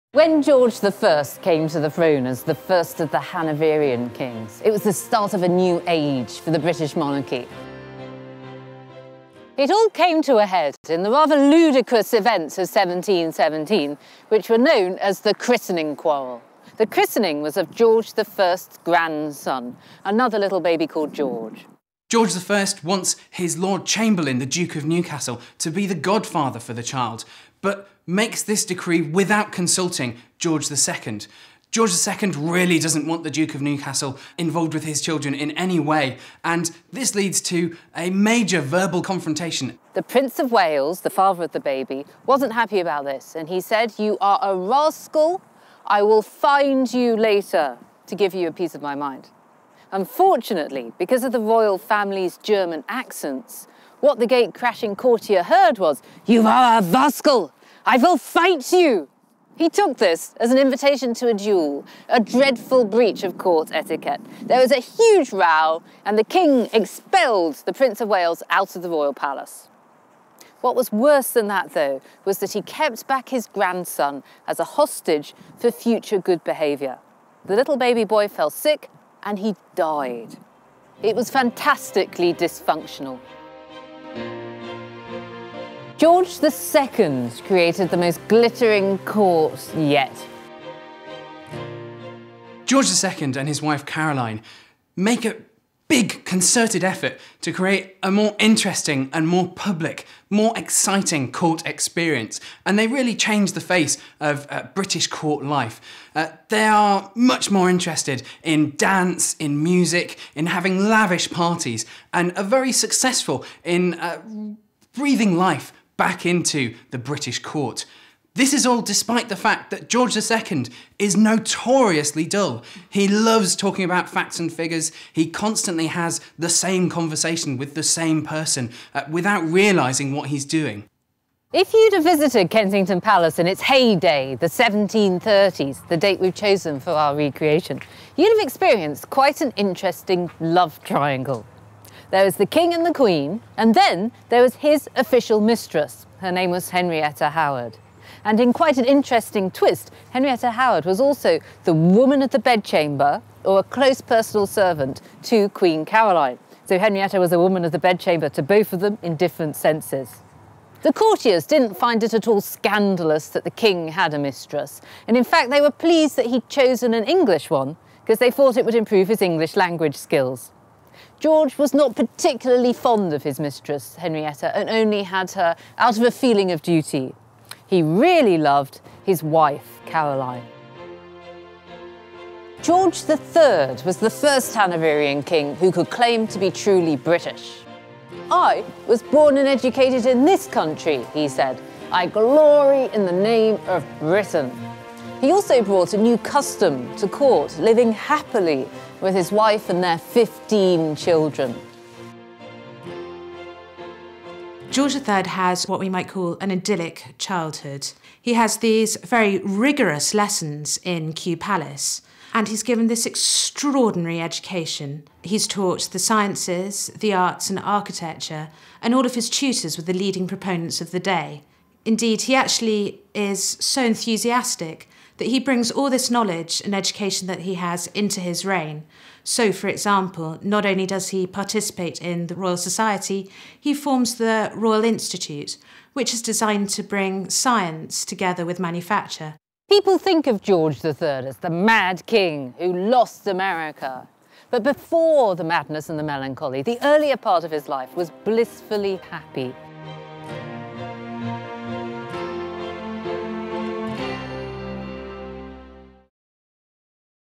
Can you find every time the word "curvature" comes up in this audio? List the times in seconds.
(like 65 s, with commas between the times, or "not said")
not said.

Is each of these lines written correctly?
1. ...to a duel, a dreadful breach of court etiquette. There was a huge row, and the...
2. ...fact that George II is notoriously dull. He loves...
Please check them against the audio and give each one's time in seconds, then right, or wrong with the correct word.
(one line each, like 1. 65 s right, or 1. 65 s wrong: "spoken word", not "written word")
1. 61 s right
2. 119 s right.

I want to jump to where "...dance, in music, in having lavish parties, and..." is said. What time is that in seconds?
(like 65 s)
108 s.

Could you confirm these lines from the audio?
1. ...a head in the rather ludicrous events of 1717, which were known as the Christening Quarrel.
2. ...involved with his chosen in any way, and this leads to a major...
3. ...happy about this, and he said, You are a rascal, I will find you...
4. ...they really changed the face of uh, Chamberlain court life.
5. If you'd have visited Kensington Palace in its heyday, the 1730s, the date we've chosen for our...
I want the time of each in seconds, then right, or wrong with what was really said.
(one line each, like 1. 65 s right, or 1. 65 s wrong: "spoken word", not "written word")
1. 10 s right
2. 34 s wrong: "children", not "chosen"
3. 42 s right
4. 102 s wrong: "British", not "Chamberlain"
5. 131 s right.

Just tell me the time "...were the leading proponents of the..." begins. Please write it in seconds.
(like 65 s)
219 s.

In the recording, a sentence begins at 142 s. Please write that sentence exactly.
There was the King and the Queen, and then there was his official mistress.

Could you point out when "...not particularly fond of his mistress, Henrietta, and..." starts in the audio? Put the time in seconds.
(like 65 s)
171 s.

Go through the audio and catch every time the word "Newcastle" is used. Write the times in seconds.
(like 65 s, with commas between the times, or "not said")
24 s, 33 s.